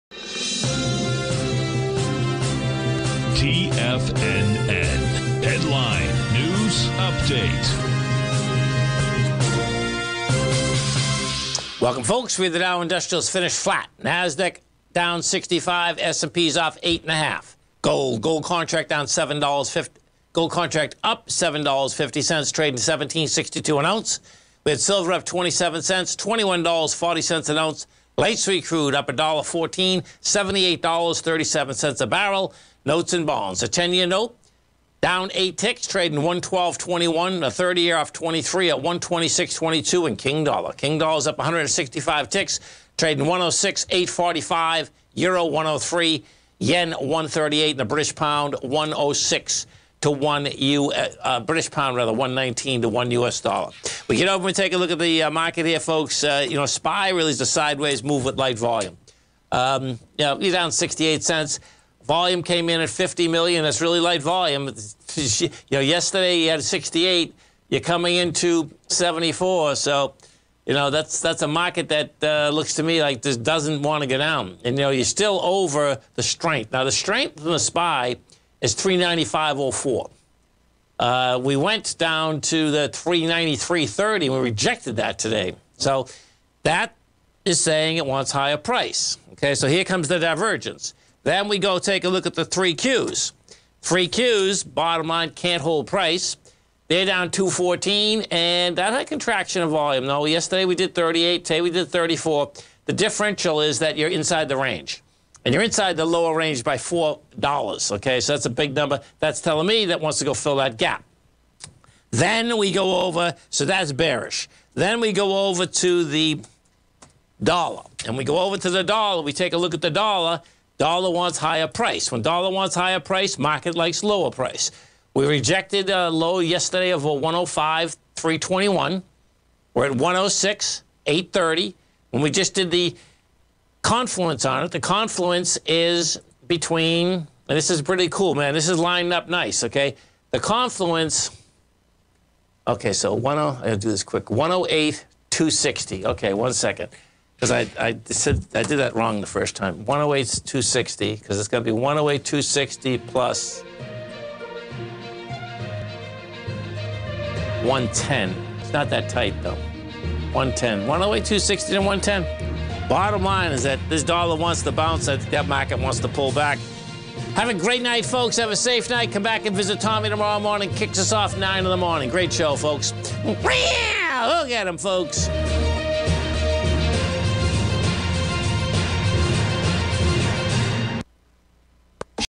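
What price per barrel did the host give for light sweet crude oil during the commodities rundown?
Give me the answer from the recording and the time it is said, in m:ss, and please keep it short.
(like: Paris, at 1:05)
$78.37, at 0:30.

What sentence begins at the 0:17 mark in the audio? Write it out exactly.
Gold, gold contract down seven dollars fifty.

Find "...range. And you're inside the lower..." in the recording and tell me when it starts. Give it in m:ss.
1:44.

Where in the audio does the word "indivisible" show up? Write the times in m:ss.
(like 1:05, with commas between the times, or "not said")
not said.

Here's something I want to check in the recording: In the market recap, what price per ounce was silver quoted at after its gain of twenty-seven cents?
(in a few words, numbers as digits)
$21.40.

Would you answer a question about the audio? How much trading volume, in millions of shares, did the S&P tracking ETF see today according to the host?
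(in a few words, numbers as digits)
50 million.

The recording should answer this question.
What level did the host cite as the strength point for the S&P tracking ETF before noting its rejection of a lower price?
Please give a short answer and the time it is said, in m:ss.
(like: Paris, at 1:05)
395.04, at 1:18.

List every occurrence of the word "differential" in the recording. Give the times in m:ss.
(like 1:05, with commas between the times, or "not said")
1:42.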